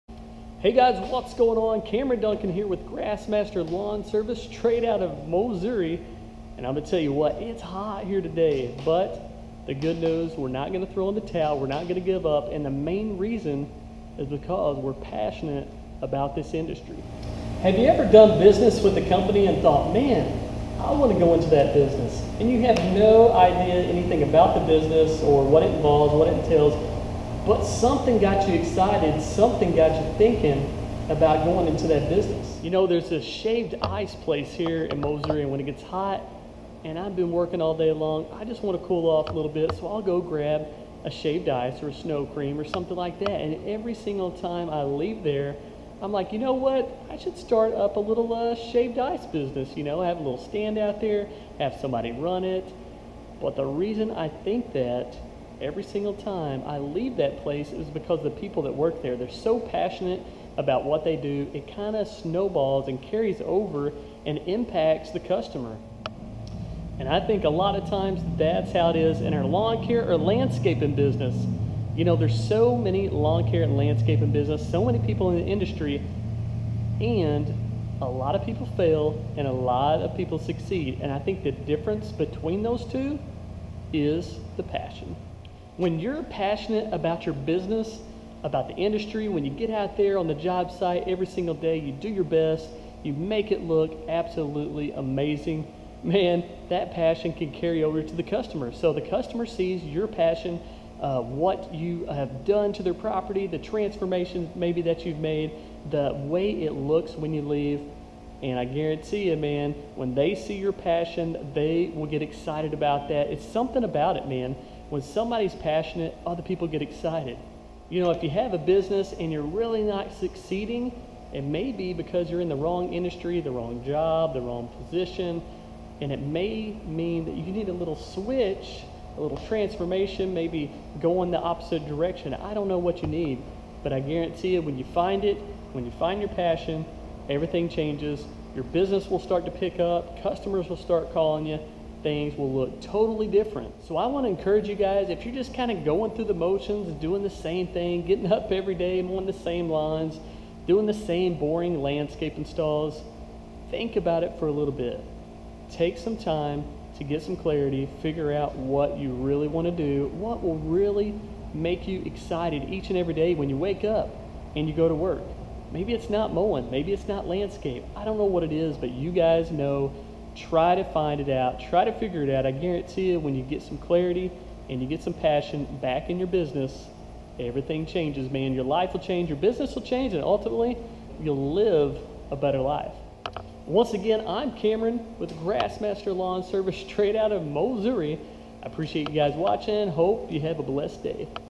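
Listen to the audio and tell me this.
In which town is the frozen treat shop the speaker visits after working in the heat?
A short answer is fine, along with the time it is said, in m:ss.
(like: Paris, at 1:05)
Moser, at 0:35.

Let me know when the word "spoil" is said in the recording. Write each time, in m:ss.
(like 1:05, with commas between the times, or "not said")
not said.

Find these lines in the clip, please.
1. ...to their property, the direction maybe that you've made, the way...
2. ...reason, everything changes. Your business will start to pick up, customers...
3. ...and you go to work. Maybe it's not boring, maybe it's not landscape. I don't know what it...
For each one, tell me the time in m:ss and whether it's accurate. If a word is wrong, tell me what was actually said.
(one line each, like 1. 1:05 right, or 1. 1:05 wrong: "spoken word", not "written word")
1. 1:42 wrong: "transformation", not "direction"
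2. 2:16 wrong: "passion", not "reason"
3. 2:44 wrong: "mowing", not "boring".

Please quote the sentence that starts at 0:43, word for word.
And every single time I leave there, I'm like, you know what?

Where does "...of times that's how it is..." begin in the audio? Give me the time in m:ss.
1:07.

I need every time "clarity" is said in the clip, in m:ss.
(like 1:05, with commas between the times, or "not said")
2:37, 2:53.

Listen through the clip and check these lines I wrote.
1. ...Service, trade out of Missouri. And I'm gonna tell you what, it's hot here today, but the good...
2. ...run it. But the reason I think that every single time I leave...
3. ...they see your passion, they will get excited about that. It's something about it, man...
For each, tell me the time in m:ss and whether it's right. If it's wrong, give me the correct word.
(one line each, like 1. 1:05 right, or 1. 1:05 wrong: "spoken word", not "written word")
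1. 0:04 right
2. 0:52 right
3. 1:50 right.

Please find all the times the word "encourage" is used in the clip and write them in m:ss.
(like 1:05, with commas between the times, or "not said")
2:24.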